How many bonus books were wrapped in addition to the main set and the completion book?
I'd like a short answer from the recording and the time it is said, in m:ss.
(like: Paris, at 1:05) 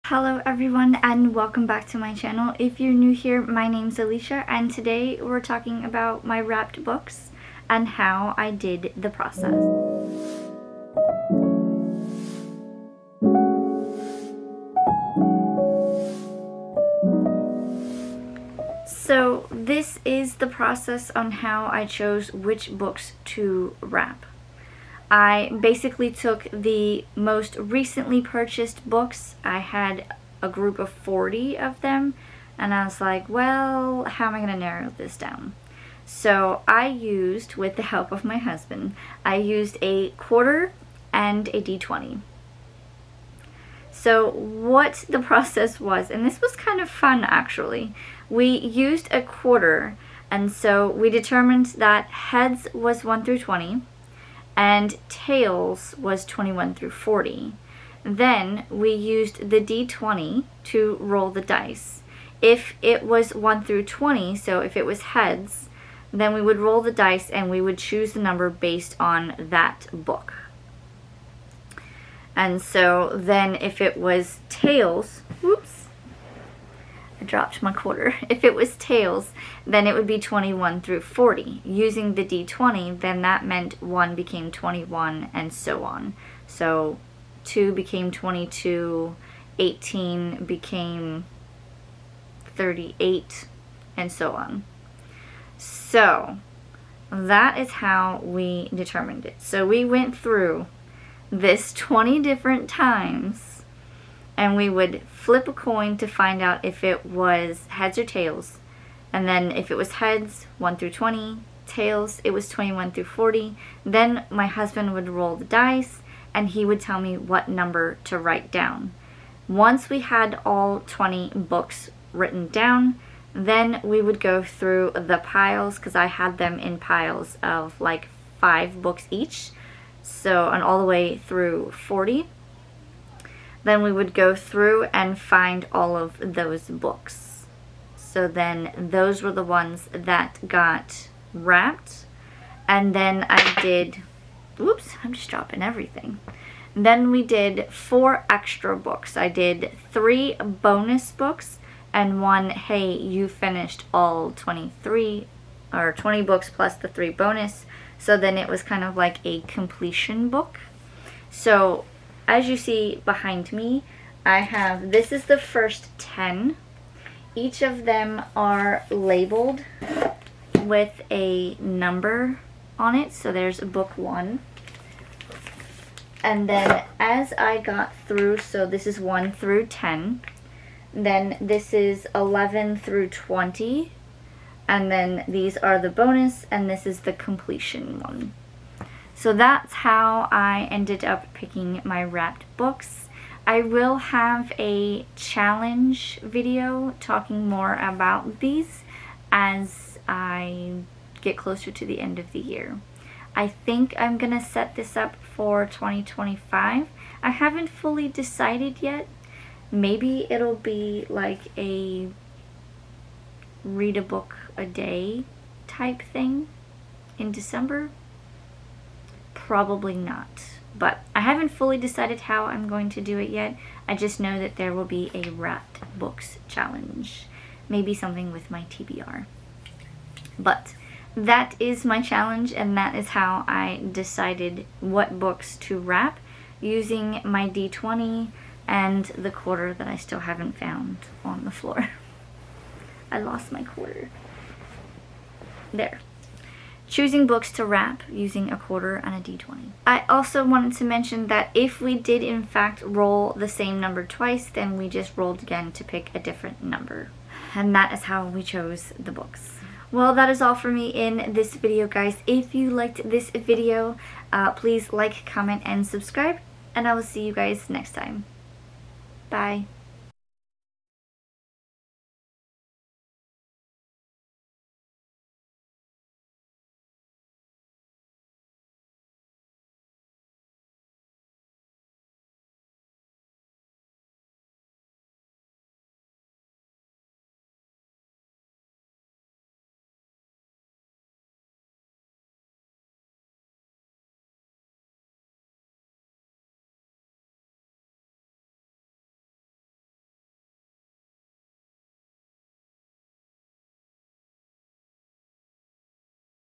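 3, at 2:29.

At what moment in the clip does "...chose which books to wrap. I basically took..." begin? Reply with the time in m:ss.
0:21.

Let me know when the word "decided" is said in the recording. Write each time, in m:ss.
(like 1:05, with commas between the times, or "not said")
3:28, 3:41, 3:53.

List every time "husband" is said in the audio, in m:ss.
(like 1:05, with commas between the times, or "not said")
0:38, 1:54.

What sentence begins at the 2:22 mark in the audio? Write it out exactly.
And then I did, whoops, I'm just dropping everything.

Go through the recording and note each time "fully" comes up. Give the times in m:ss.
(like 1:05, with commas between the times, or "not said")
3:27, 3:41.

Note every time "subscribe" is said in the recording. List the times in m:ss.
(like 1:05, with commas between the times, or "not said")
4:25.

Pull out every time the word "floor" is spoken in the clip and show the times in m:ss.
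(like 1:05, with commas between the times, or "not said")
4:01.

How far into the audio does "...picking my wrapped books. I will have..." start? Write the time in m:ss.
3:11.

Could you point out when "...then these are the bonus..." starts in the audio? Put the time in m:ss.
3:04.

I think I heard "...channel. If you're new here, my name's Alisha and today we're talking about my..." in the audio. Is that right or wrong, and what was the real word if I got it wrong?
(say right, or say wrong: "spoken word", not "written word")
right.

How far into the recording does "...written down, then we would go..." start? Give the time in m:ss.
2:02.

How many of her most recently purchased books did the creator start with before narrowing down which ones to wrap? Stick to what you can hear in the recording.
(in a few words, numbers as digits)
40.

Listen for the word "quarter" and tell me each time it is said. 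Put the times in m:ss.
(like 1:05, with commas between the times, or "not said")
0:40, 0:49, 1:17, 3:59, 4:03, 4:08.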